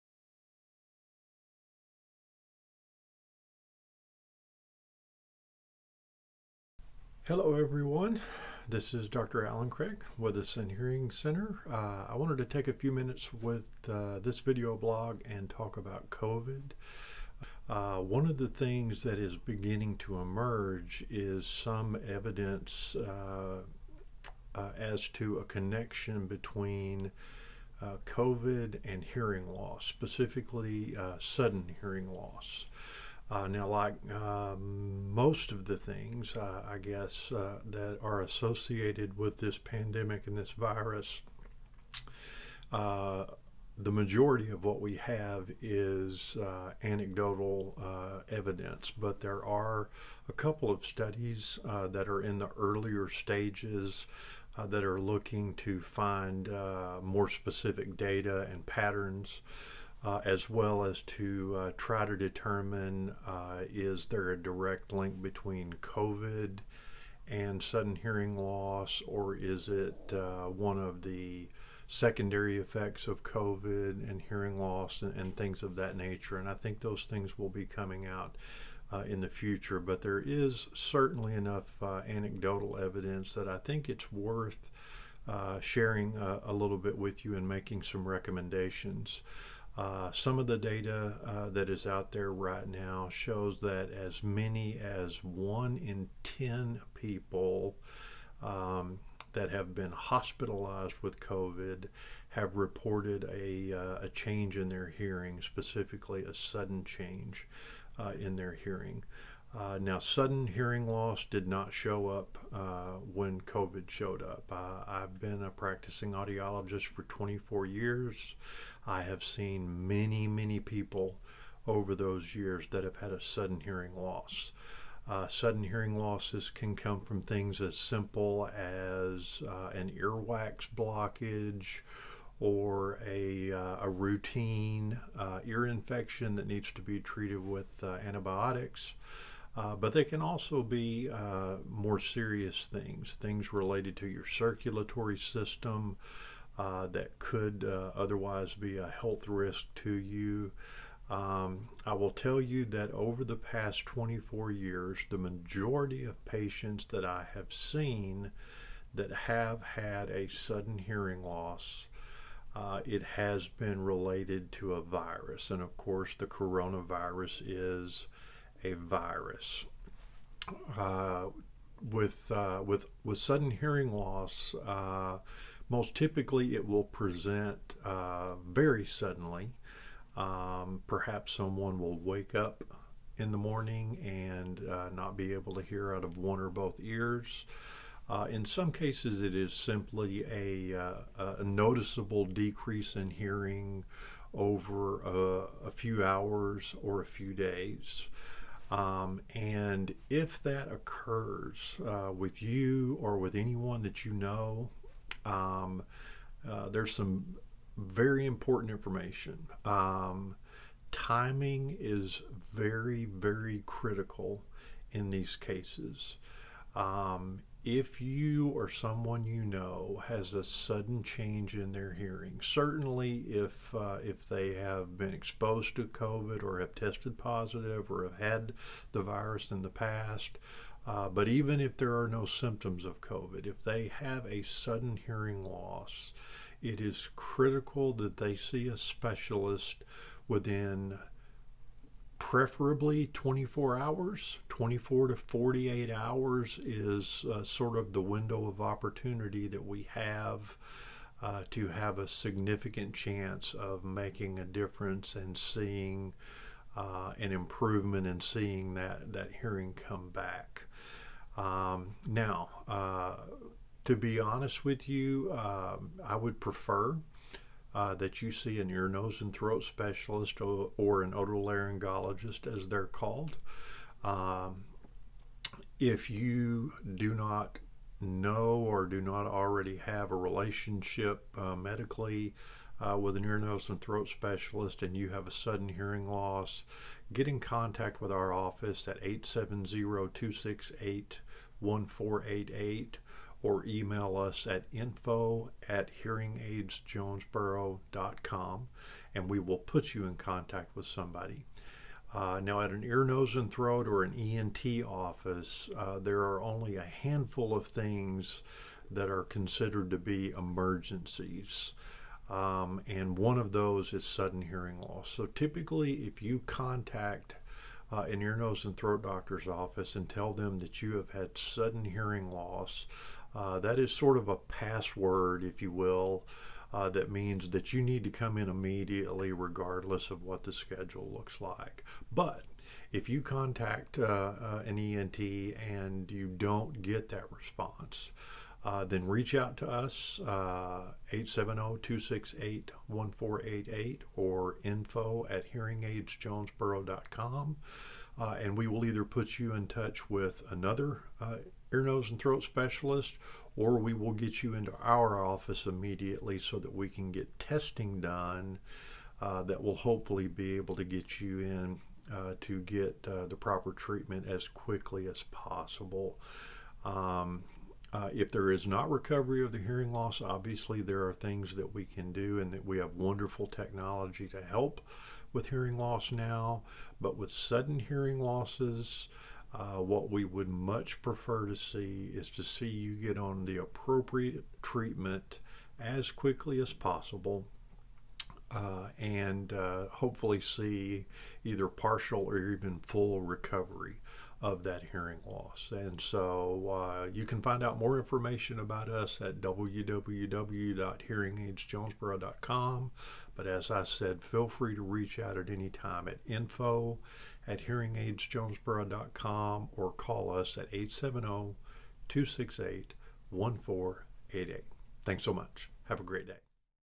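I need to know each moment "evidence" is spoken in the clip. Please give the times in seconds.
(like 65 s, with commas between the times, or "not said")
22 s, 48 s, 82 s.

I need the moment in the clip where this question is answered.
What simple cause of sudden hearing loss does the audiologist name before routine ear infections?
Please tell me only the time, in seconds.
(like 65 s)
129 s.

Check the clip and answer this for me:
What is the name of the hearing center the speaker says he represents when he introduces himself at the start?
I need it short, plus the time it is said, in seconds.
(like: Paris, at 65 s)
Sin Hearing Center, at 10 s.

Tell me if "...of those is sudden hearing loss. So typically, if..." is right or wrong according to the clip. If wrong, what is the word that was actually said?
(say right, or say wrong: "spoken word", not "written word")
right.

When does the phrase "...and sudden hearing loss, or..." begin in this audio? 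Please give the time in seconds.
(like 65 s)
67 s.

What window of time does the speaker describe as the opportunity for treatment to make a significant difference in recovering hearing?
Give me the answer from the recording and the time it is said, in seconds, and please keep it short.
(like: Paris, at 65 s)
24 to 48 hours, at 244 s.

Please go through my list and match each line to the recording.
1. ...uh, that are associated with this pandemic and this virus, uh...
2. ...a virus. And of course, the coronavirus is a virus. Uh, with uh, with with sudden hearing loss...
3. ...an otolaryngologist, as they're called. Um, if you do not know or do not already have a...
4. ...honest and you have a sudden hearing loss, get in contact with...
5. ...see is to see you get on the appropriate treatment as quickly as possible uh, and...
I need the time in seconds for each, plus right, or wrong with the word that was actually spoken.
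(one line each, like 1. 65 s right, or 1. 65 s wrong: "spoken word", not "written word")
1. 37 s right
2. 164 s right
3. 271 s right
4. 284 s wrong: "specialist", not "honest"
5. 381 s right.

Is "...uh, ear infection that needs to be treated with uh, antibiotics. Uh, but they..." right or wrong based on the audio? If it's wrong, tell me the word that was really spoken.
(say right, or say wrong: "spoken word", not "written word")
right.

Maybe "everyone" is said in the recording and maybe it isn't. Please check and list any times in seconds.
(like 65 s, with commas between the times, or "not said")
7 s.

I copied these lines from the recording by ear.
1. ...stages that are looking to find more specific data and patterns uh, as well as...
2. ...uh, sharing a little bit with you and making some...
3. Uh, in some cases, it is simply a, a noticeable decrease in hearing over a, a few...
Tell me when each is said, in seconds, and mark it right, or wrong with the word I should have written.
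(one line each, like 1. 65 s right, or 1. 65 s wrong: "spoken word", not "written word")
1. 53 s right
2. 85 s right
3. 188 s right.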